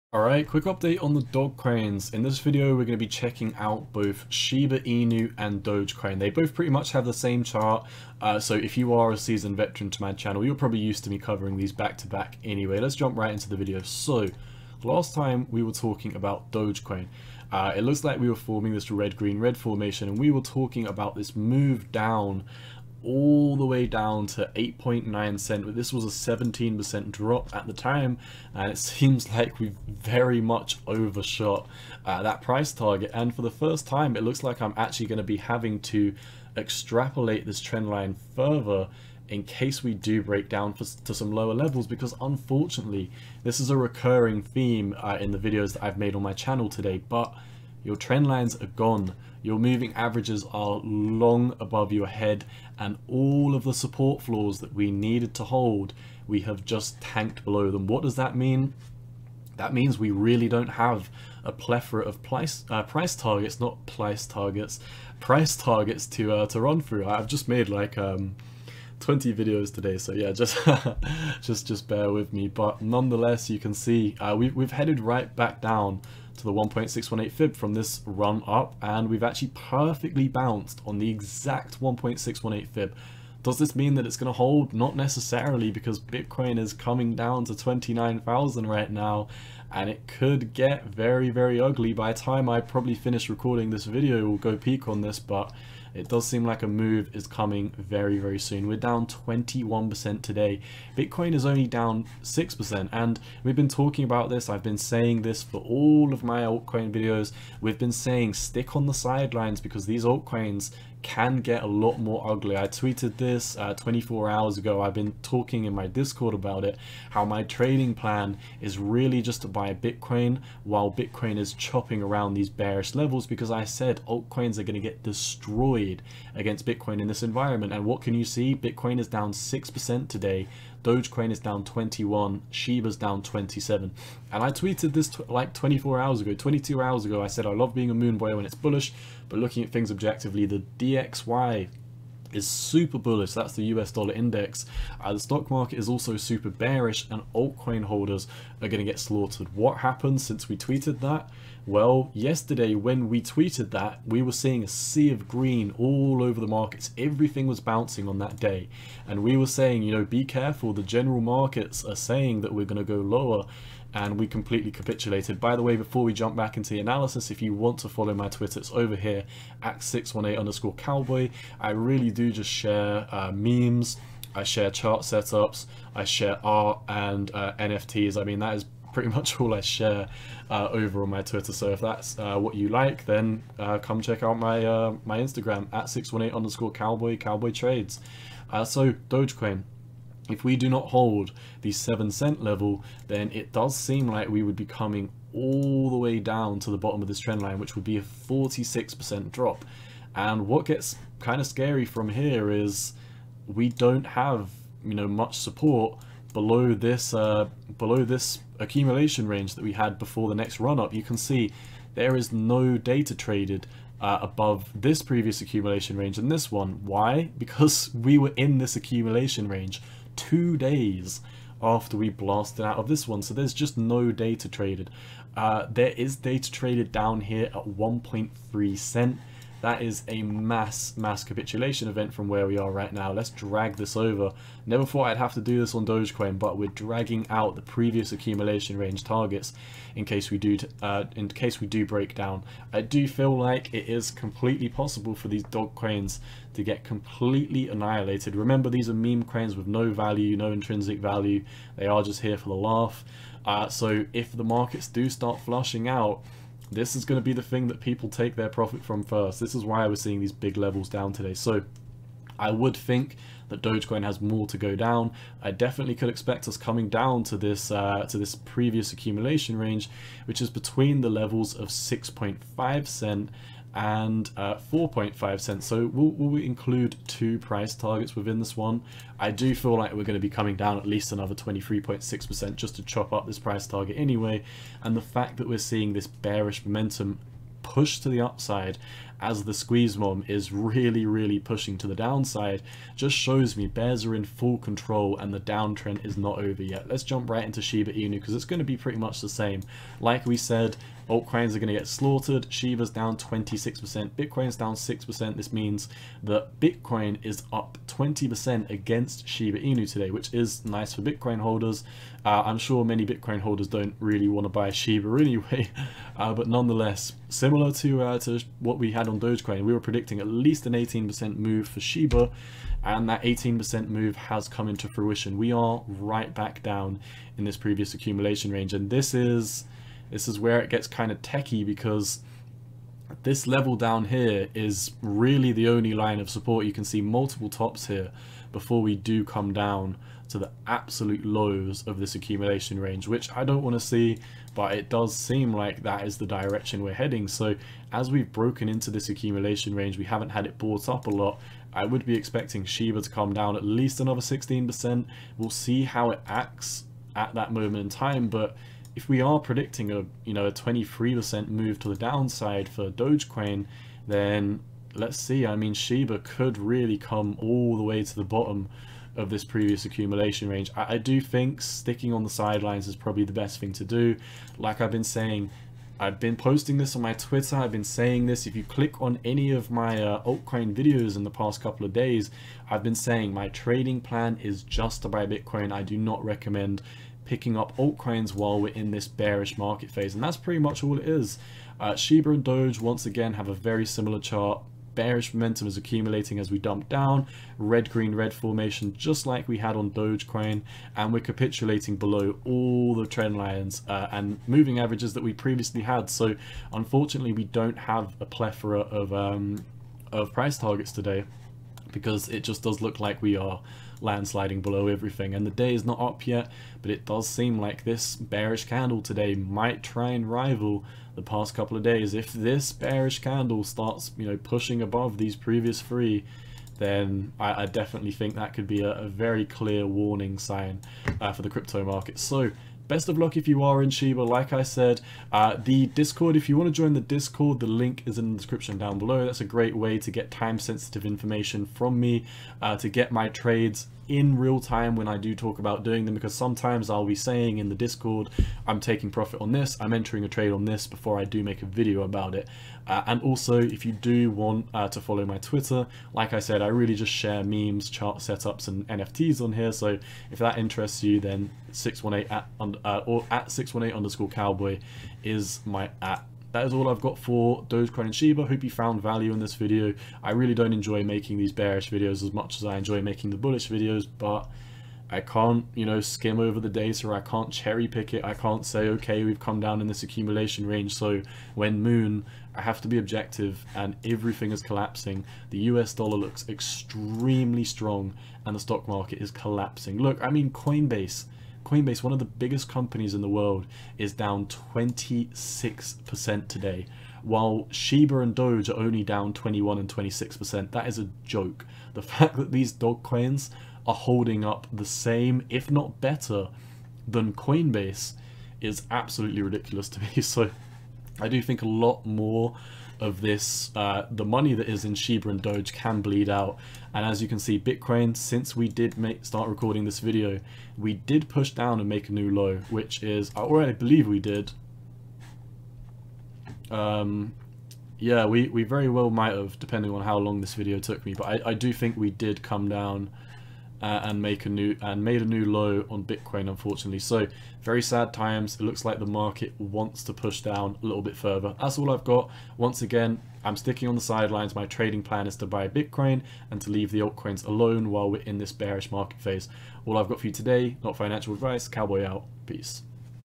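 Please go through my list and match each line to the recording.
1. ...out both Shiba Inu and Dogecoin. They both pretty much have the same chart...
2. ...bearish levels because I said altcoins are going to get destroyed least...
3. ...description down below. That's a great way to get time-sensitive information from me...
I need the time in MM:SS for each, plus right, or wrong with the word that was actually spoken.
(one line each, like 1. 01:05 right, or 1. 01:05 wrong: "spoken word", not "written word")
1. 00:03 right
2. 02:02 wrong: "against", not "least"
3. 07:18 right.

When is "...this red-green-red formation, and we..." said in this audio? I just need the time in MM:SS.
00:18.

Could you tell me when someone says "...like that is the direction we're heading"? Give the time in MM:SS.
05:45.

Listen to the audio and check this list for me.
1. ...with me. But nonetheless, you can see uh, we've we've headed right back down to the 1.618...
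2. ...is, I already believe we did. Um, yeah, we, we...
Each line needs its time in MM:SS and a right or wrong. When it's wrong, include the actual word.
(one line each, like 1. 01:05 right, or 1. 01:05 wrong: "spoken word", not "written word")
1. 01:12 right
2. 08:43 right.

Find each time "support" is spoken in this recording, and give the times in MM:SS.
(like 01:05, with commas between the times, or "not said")
00:53, 03:25, 05:36.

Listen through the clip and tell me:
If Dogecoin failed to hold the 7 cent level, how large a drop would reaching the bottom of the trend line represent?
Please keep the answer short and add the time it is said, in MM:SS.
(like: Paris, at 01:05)
46%, at 03:18.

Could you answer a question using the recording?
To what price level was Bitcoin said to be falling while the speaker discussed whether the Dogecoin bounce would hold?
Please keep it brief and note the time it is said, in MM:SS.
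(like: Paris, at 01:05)
29,000, at 01:27.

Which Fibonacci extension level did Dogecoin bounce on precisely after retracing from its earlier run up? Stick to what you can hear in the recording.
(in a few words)
1.618.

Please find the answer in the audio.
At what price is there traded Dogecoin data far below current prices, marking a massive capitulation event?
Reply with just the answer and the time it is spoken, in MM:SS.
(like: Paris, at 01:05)
1.3 cents, at 03:47.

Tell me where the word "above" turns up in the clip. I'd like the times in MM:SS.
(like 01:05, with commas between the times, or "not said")
00:51, 03:34, 07:04.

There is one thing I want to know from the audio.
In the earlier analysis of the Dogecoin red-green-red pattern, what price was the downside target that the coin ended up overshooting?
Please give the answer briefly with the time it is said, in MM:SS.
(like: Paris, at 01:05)
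8.9 cents, at 00:24.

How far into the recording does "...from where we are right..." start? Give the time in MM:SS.
03:52.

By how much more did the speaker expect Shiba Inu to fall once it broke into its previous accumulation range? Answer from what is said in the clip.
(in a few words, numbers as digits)
16%.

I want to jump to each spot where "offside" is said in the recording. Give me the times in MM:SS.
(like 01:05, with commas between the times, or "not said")
not said.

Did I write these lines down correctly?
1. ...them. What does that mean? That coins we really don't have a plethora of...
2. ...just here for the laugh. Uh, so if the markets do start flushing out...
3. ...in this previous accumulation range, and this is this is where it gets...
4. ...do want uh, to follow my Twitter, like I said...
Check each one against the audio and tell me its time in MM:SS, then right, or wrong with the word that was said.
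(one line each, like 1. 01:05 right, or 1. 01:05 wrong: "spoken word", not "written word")
1. 00:57 wrong: "means", not "coins"
2. 04:12 right
3. 05:27 right
4. 07:33 right.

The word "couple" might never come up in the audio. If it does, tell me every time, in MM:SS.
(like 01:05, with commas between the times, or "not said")
06:21, 07:01.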